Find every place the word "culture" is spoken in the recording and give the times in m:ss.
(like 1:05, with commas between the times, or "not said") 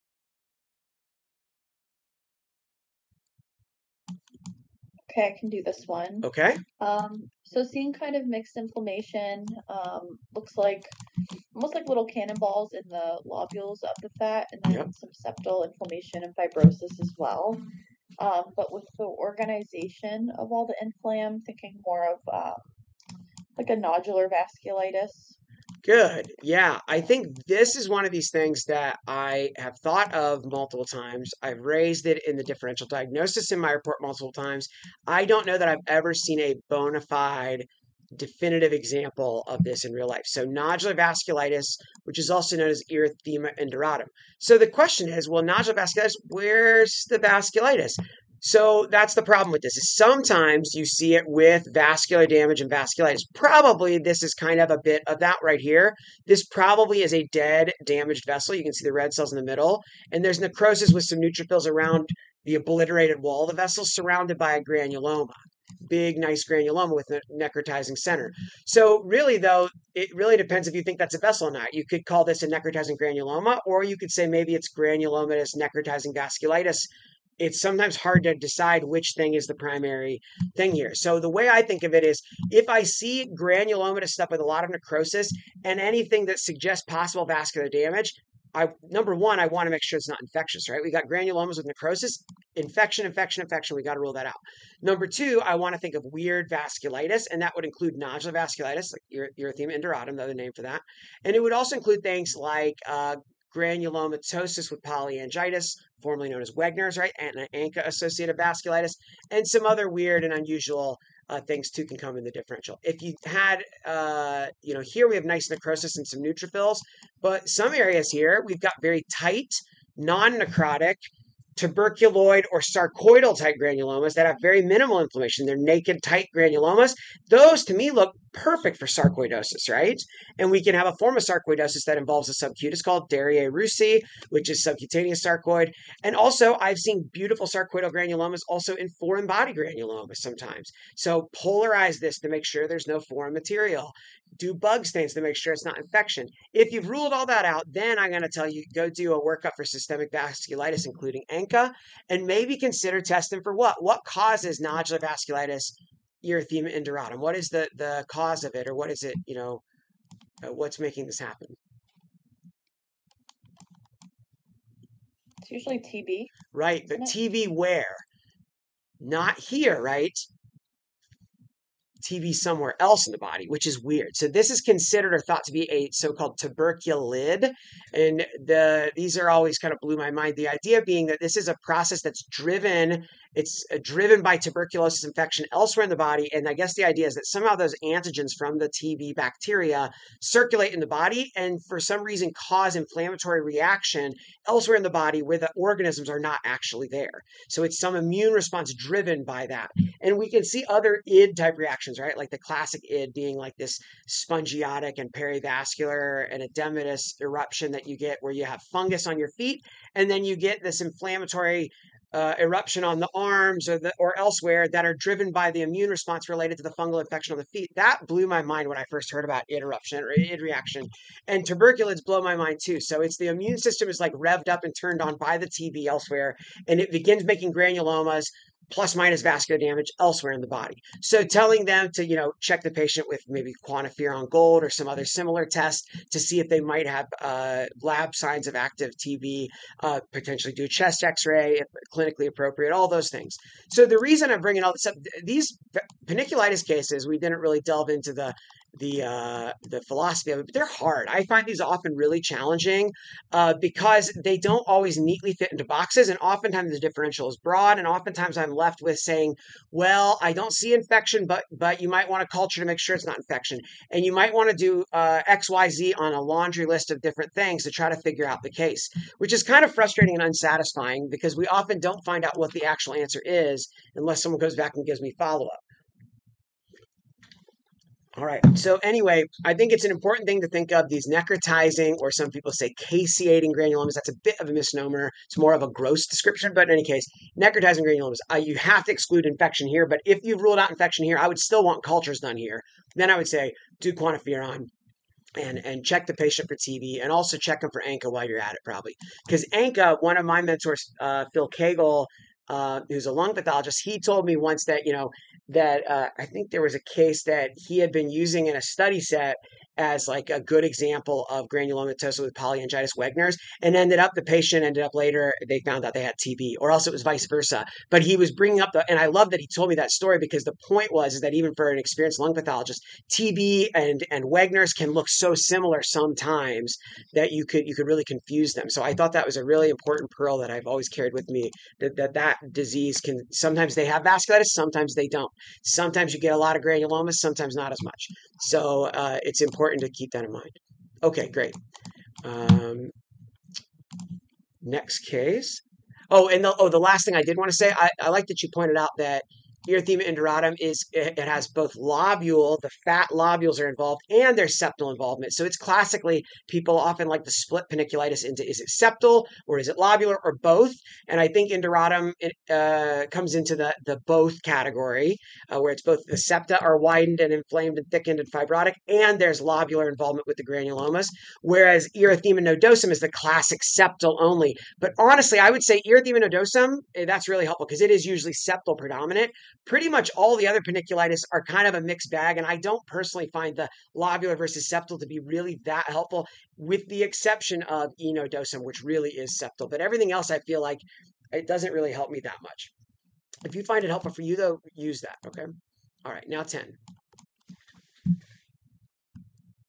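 4:22, 4:51.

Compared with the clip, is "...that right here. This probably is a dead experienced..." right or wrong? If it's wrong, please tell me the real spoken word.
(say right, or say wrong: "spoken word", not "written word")
wrong: "damaged", not "experienced".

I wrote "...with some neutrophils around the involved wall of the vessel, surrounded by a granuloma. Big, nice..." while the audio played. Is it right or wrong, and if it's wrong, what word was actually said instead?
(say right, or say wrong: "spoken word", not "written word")
wrong: "obliterated", not "involved".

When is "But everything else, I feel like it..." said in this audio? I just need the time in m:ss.
6:29.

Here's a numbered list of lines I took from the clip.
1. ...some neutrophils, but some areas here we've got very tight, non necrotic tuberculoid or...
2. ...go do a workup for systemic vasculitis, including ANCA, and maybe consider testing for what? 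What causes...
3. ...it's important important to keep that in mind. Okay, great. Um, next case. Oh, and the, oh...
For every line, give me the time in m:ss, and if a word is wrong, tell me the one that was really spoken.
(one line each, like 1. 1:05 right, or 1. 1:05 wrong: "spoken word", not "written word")
1. 1:56 right
2. 2:28 right
3. 5:39 right.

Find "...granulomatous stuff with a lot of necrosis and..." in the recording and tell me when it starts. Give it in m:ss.
1:23.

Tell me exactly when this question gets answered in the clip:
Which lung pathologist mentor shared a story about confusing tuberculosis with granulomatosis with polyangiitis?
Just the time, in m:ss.
5:01.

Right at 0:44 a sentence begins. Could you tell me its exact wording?
So the question is, well, nodular vasculitis, where's the vasculitis?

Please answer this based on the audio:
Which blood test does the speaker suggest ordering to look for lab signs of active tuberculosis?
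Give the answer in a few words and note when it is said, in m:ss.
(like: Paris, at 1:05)
QuantiFERON gold, at 3:53.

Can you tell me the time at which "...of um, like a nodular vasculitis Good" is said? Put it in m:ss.
0:22.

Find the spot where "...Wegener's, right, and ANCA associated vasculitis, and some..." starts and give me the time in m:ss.
1:46.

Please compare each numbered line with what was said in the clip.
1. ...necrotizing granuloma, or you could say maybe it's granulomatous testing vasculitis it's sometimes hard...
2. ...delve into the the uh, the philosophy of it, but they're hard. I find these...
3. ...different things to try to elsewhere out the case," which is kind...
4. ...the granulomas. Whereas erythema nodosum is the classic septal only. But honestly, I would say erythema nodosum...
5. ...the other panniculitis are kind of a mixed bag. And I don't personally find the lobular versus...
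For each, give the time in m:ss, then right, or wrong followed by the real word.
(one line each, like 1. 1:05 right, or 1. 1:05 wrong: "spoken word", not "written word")
1. 1:12 wrong: "necrotizing", not "testing"
2. 4:07 right
3. 4:27 wrong: "figure", not "elsewhere"
4. 6:10 right
5. 6:20 right.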